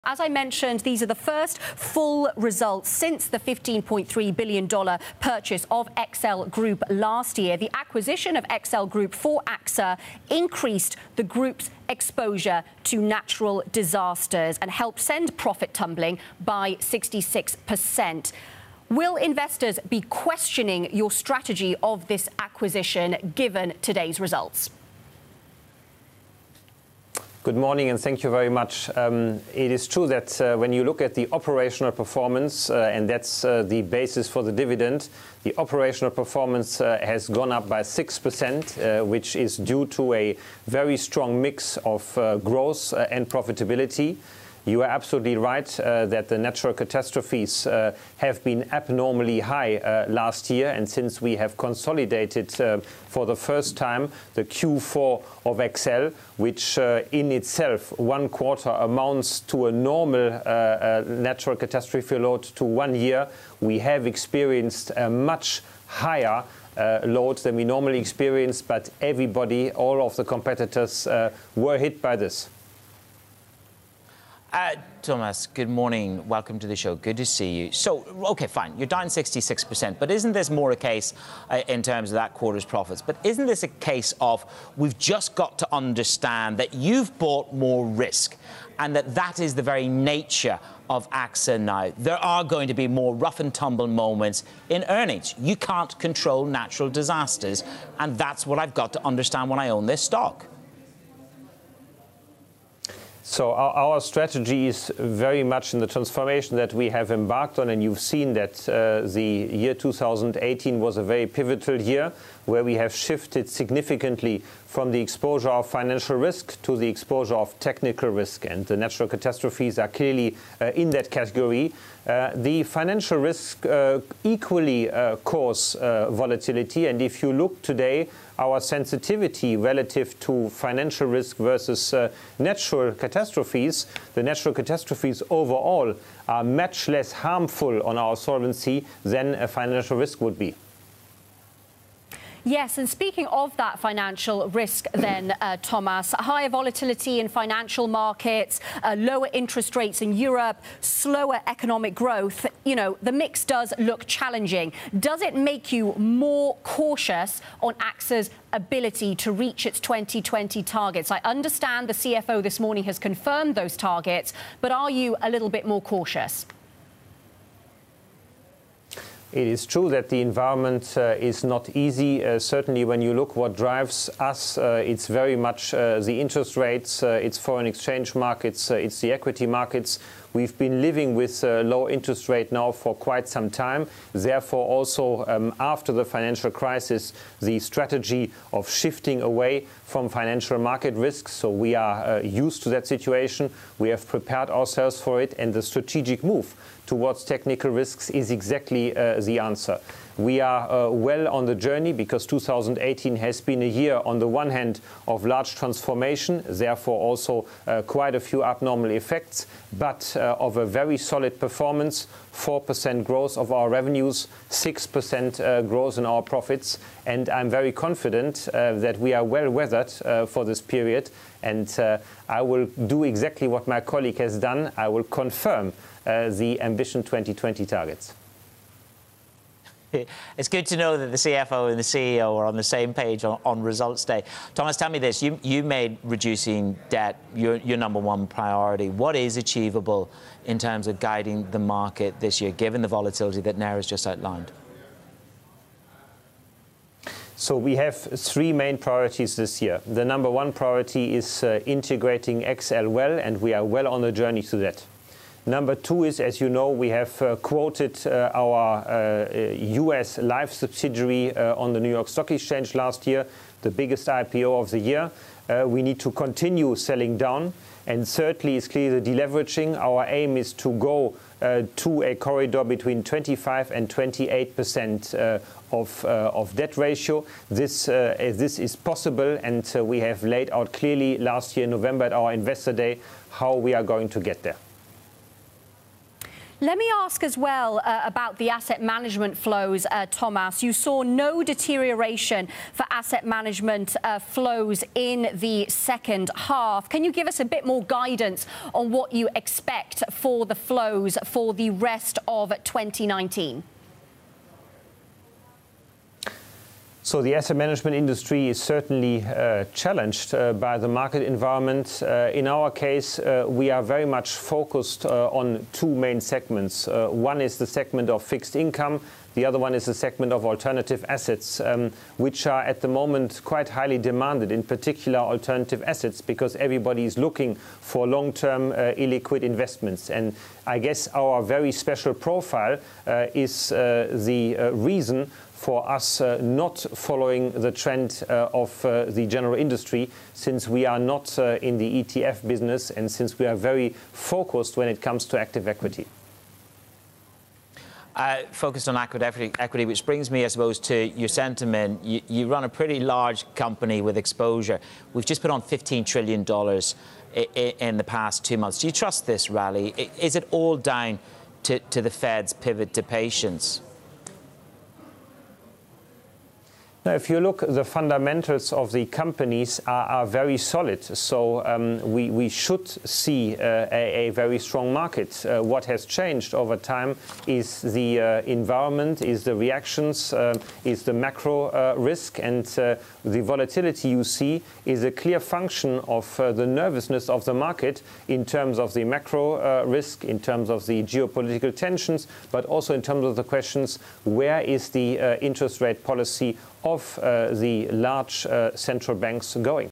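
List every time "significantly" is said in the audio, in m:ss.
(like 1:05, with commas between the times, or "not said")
1:53.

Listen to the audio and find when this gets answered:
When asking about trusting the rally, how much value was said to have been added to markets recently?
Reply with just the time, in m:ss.
5:55.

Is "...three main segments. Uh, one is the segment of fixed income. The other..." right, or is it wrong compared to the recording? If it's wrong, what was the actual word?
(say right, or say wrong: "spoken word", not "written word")
wrong: "two", not "three".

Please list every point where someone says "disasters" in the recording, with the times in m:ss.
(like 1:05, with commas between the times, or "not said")
0:13, 1:36.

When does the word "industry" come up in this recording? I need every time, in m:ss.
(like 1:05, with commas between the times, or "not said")
5:07, 5:39.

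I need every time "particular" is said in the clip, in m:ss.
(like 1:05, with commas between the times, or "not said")
5:24.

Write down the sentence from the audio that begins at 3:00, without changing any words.
We've been living with uh, low interest rate now for quite some time.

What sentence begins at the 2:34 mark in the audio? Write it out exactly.
Does it make you more cautious on AXA's ability to reach its 2020 targets?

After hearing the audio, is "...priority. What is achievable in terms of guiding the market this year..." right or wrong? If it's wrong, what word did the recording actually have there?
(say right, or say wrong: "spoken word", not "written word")
right.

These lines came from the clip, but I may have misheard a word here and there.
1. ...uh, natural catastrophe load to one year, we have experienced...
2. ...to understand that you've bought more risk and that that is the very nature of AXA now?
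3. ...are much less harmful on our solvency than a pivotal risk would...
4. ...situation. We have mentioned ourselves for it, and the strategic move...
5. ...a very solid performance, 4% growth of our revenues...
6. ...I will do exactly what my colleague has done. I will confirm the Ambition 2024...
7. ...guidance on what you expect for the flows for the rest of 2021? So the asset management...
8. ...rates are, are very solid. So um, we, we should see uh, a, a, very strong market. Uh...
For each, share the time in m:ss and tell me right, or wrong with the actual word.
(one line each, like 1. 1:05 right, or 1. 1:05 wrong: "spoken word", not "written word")
1. 1:00 right
2. 1:25 right
3. 2:16 wrong: "financial", not "pivotal"
4. 3:12 wrong: "prepared", not "mentioned"
5. 3:30 right
6. 3:42 wrong: "2020", not "2024"
7. 4:57 wrong: "2019", not "2021"
8. 6:09 wrong: "companies", not "rates".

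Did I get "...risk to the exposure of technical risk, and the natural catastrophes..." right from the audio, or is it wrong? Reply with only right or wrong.
right.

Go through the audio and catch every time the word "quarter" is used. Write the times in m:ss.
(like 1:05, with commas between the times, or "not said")
0:58, 1:22.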